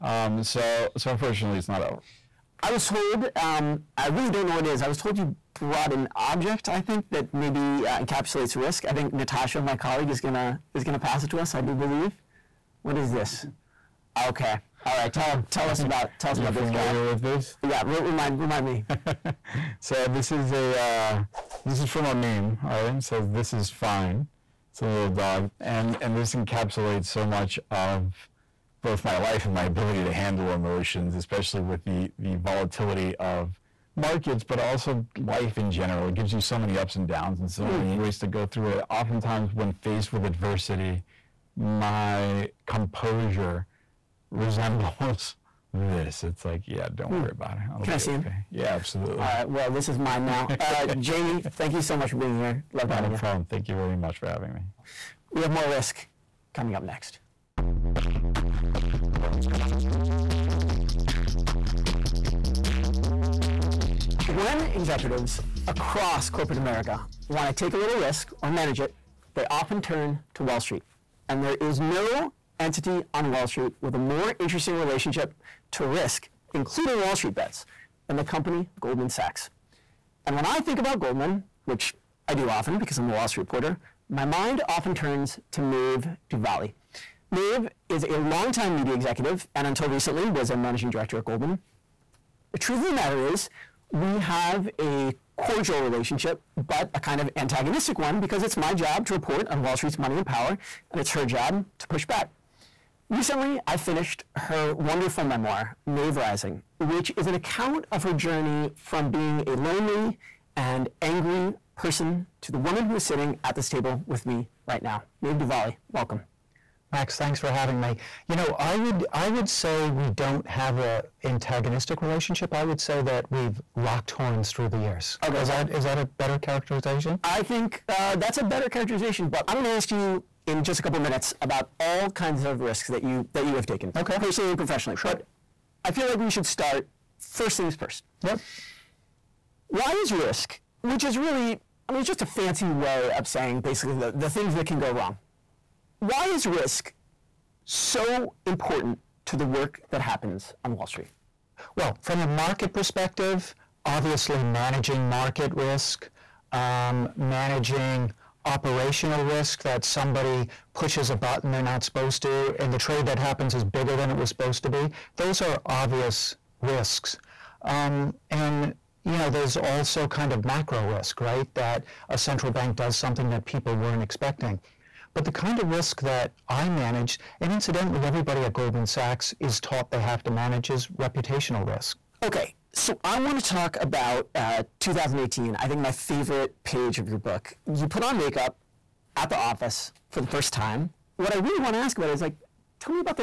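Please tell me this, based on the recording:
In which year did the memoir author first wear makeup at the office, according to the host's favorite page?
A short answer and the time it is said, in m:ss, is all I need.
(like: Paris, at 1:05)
2018, at 3:04.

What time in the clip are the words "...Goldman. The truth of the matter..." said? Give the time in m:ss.
1:31.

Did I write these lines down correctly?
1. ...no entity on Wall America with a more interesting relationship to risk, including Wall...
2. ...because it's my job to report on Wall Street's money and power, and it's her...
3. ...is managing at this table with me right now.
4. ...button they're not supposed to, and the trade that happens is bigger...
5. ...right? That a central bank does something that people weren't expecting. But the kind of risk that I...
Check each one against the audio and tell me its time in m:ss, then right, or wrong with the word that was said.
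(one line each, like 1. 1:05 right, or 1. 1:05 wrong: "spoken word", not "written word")
1. 1:11 wrong: "Street", not "America"
2. 1:38 right
3. 1:52 wrong: "sitting", not "managing"
4. 2:41 right
5. 2:51 right.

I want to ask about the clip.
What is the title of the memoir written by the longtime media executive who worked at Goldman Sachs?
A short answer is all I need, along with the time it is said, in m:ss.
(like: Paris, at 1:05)
Maeve Rising, at 1:45.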